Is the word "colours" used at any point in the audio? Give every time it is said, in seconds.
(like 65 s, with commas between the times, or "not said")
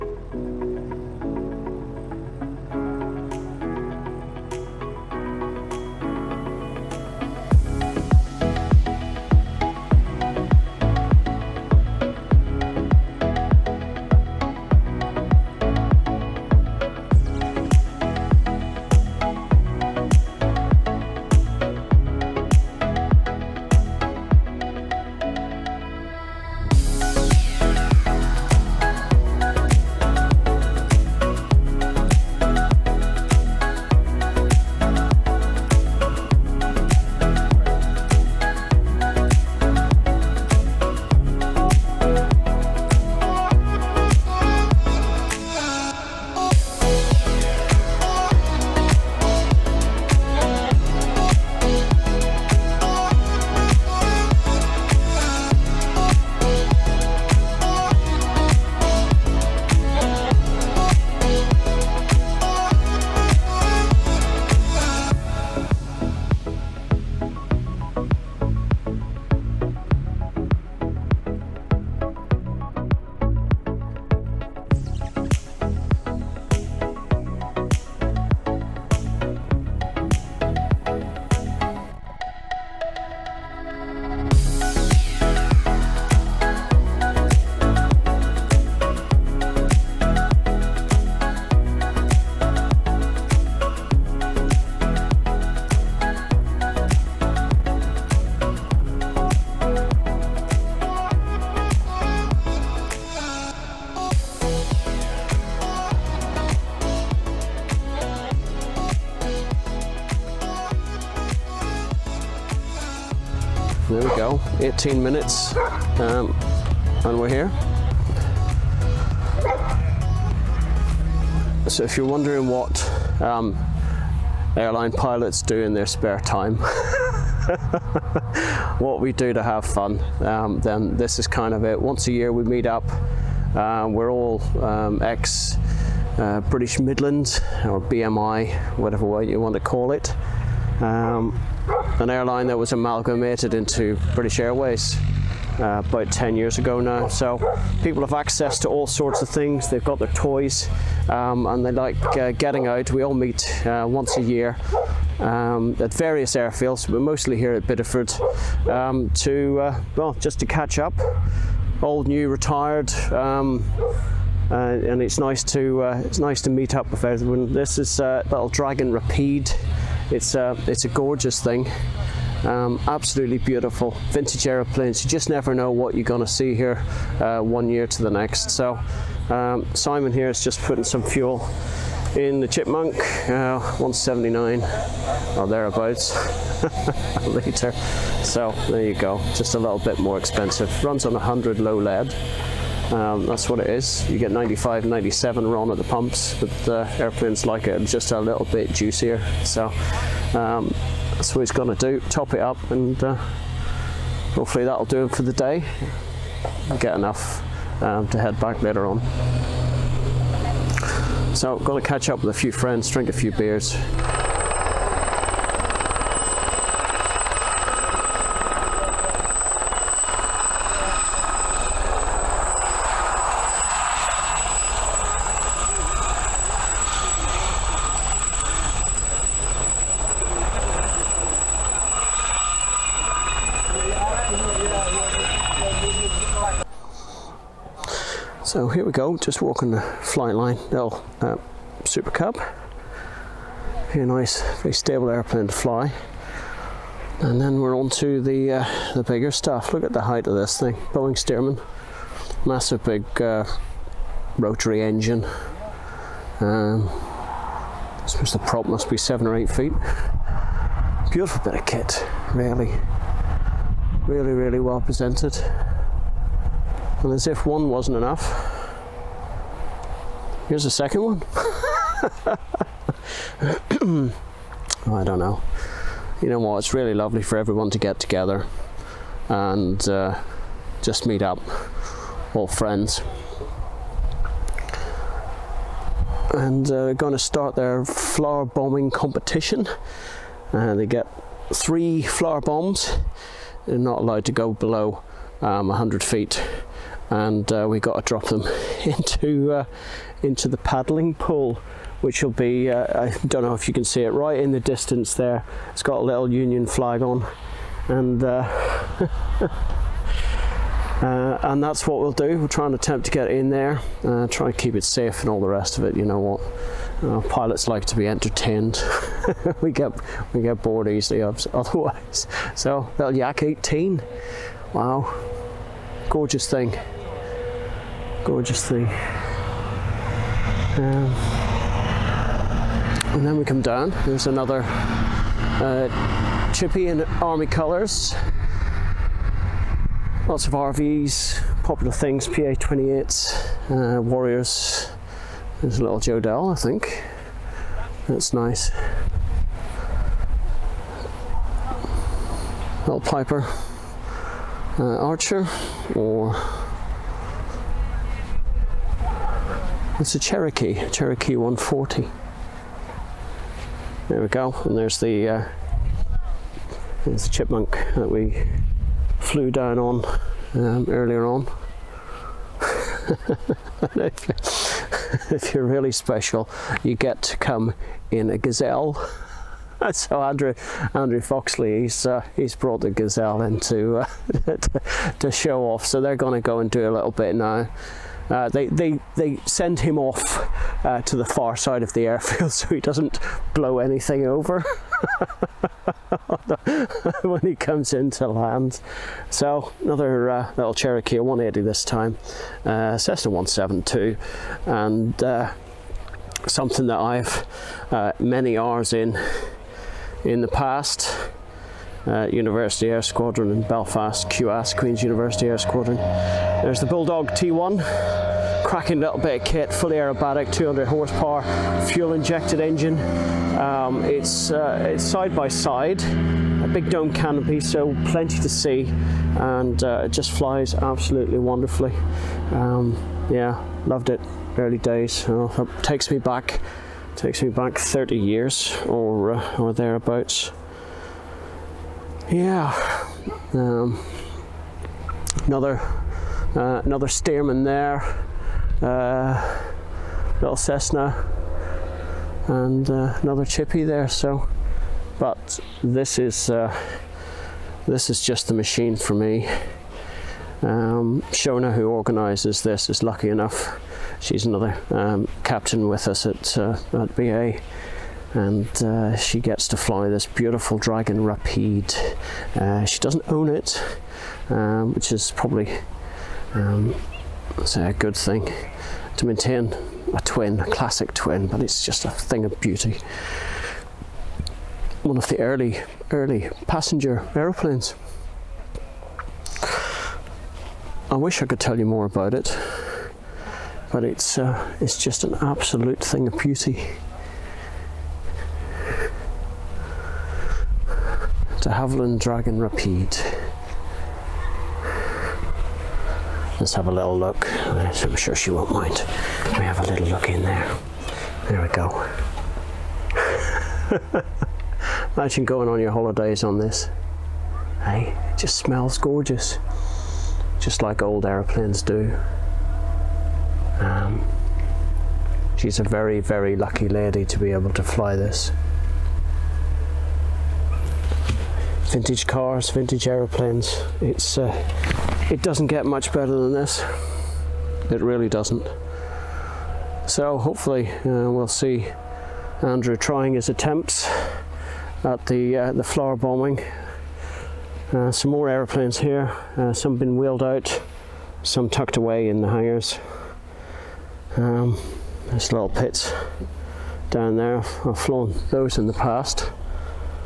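337 s.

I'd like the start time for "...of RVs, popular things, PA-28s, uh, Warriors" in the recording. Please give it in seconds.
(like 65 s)
340 s.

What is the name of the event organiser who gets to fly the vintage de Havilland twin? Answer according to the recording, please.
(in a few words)
Shona.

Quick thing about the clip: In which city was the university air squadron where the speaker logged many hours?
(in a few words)
Belfast.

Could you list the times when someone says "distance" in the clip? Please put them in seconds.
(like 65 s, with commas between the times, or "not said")
304 s.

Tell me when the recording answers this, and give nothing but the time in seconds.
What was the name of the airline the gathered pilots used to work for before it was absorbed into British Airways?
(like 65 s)
136 s.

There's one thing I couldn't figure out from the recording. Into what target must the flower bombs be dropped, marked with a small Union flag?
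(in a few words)
The paddling pool.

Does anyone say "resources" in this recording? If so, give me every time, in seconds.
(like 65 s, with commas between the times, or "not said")
not said.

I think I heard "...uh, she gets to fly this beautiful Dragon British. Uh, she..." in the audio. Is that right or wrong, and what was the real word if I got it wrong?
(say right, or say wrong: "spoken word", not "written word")
wrong: "Rapide", not "British".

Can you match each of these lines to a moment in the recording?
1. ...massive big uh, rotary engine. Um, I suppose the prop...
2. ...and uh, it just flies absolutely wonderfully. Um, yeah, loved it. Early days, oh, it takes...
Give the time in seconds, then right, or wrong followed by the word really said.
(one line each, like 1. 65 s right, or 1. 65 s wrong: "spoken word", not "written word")
1. 252 s right
2. 429 s right.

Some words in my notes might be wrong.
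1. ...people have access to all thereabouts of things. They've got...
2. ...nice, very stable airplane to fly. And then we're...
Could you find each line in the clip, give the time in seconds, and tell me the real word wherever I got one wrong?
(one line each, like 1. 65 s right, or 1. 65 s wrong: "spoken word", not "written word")
1. 147 s wrong: "sorts", not "thereabouts"
2. 244 s right.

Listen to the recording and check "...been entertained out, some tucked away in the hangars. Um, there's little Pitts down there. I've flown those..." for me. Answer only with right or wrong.
wrong.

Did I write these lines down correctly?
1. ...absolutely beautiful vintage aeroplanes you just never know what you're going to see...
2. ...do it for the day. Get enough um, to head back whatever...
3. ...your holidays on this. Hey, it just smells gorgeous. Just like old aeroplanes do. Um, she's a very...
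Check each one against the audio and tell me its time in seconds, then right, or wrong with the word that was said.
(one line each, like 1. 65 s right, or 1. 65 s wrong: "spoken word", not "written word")
1. 172 s right
2. 204 s wrong: "later", not "whatever"
3. 515 s right.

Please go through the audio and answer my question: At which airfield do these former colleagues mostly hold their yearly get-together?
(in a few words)
Bidford.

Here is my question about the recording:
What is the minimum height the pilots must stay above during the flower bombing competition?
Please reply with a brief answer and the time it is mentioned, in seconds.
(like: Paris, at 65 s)
100 feet, at 295 s.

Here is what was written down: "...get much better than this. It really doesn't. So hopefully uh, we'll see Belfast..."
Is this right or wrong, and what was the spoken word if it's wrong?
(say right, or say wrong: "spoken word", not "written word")
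wrong: "Andrew", not "Belfast".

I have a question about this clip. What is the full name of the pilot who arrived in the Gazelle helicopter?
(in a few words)
Andrew Foxley.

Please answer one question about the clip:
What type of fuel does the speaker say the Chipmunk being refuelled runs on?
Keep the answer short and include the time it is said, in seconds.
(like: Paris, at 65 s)
100 low lead, at 191 s.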